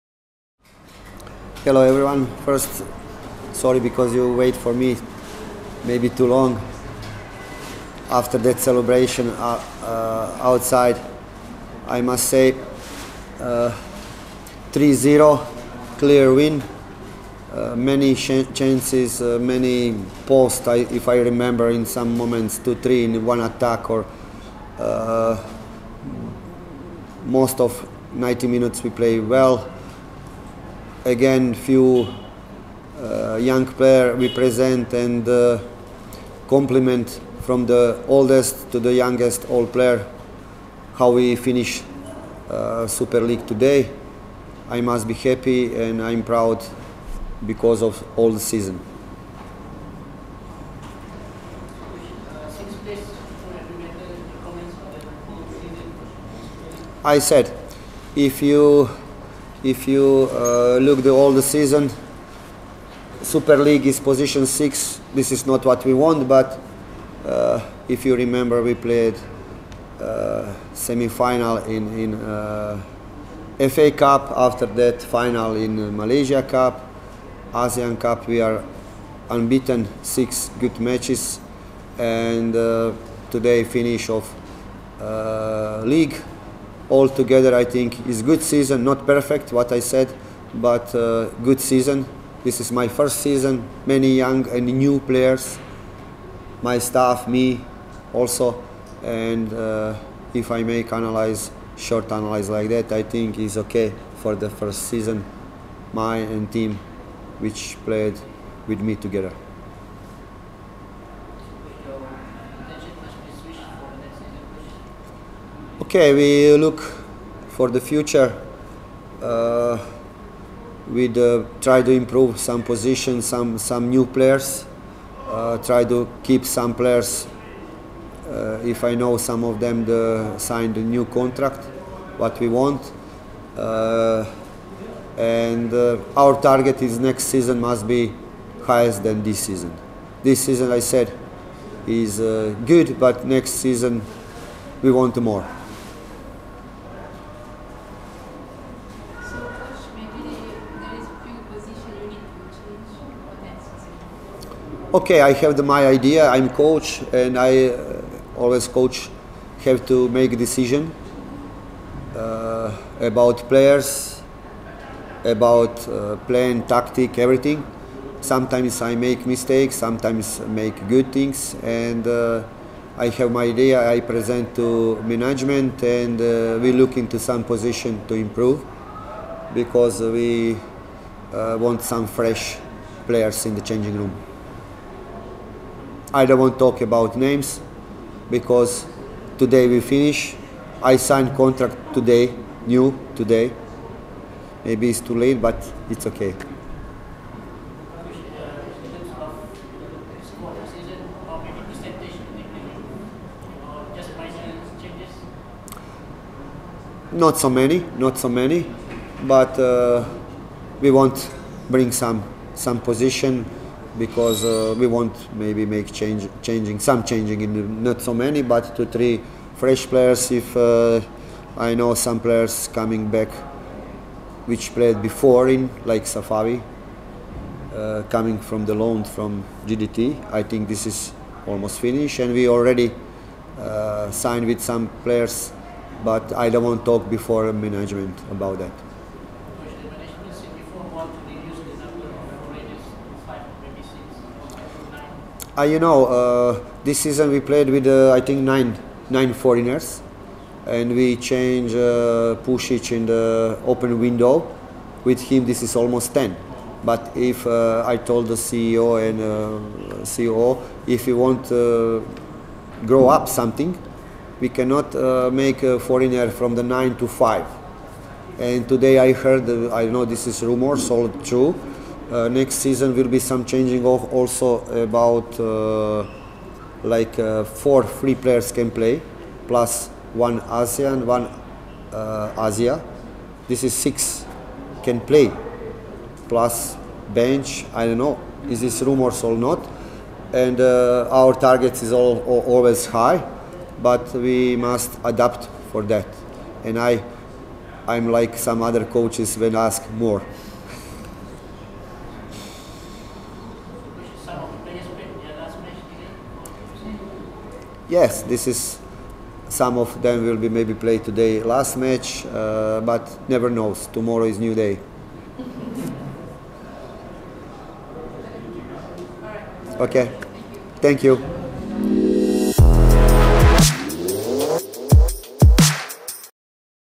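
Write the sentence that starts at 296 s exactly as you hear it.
And I, I'm like some other coaches when ask more.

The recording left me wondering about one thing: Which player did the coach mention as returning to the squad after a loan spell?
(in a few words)
Safawi.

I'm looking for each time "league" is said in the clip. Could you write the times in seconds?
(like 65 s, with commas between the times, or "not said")
43 s, 63 s, 85 s.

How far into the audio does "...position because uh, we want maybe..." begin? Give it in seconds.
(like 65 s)
212 s.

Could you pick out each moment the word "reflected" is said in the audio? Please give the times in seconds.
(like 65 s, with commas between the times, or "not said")
not said.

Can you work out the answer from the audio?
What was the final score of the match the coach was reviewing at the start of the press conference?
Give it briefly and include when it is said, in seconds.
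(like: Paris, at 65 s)
3-0, at 13 s.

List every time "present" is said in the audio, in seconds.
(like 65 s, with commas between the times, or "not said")
34 s, 174 s.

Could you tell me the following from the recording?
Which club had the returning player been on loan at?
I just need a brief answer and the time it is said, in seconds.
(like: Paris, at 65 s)
JDT, at 229 s.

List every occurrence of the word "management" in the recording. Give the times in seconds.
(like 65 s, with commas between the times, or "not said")
175 s, 237 s.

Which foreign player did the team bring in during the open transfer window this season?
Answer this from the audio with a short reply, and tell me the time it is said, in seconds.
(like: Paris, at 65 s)
Pusic, at 252 s.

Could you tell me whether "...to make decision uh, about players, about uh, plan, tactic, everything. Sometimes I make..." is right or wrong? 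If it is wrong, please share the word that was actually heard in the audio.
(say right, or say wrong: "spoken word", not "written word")
right.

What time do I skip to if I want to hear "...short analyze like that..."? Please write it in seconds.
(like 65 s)
101 s.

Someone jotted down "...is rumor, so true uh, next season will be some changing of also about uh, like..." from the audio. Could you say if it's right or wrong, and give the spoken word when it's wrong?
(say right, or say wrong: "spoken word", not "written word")
right.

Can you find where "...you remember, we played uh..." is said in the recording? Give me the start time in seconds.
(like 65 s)
68 s.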